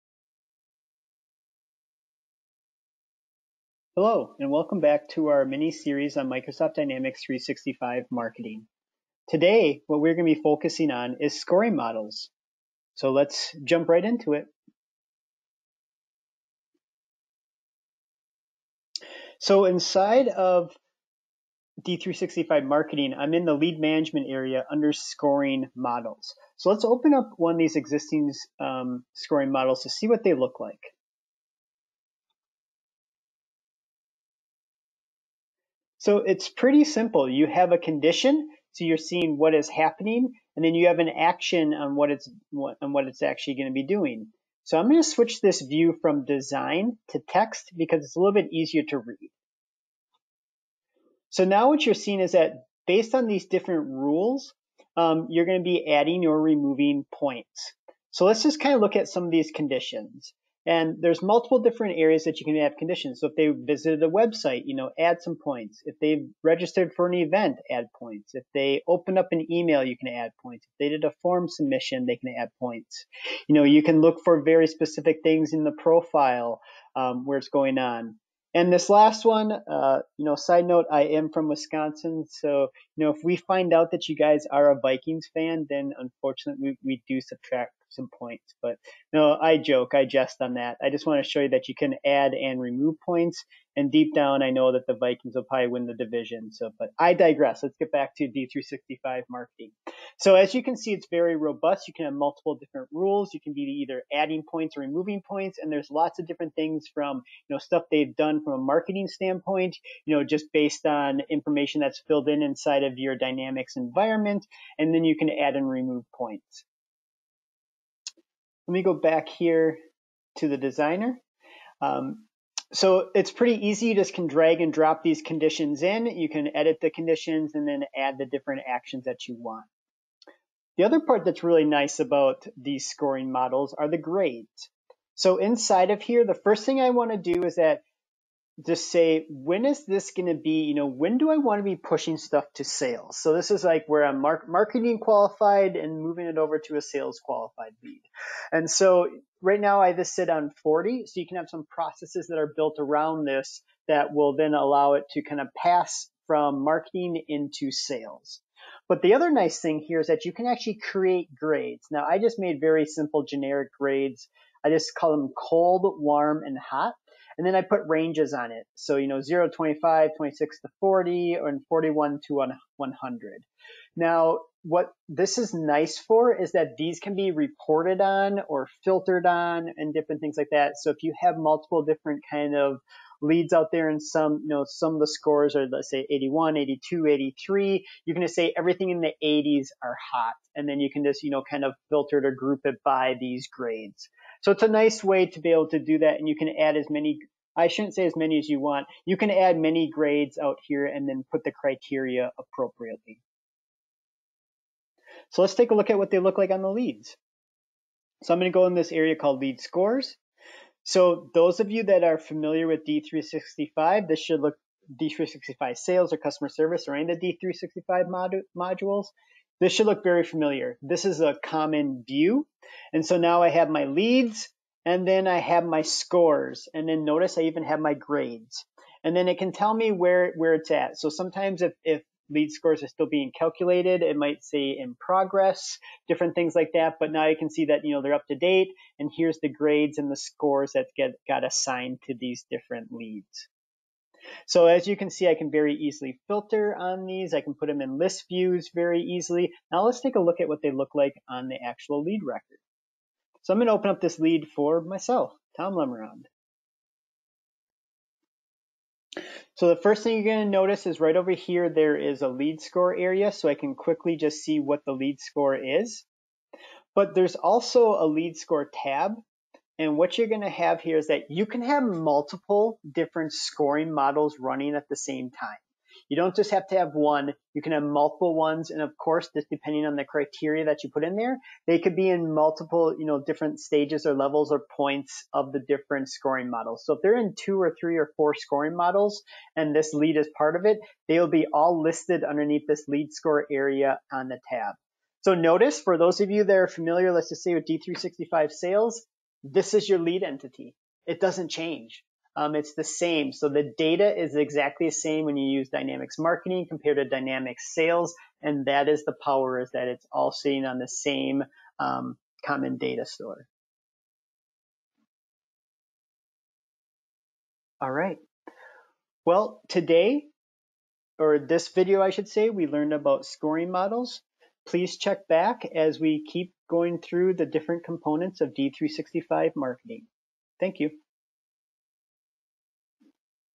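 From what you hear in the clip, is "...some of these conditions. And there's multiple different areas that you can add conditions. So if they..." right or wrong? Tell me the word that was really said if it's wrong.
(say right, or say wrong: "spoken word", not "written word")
right.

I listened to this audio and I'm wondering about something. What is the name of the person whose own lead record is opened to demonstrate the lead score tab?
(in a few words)
Tom Lemerand.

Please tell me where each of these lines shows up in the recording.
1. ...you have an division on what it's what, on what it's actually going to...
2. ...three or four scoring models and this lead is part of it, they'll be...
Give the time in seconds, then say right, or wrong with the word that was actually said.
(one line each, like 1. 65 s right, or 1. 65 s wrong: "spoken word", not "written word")
1. 40 s wrong: "action", not "division"
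2. 287 s right.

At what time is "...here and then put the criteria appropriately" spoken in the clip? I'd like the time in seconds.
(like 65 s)
200 s.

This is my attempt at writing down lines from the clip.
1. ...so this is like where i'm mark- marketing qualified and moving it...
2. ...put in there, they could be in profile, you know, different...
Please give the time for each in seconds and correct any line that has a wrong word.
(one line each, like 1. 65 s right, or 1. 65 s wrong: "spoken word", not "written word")
1. 143 s right
2. 280 s wrong: "multiple", not "profile".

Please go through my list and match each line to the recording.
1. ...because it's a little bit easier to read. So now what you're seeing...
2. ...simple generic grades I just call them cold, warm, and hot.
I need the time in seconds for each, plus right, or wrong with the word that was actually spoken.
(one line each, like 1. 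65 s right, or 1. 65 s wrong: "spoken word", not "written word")
1. 47 s right
2. 162 s right.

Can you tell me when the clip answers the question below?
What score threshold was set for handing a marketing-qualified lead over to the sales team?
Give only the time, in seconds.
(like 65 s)
150 s.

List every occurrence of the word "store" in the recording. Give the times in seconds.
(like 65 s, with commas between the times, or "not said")
313 s.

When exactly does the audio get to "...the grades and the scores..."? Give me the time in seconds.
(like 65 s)
239 s.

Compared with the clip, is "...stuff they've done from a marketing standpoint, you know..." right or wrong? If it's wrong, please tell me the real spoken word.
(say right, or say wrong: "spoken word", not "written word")
right.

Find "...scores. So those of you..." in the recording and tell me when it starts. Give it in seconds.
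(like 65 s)
209 s.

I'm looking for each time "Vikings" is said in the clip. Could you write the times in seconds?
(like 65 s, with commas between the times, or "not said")
84 s, 94 s.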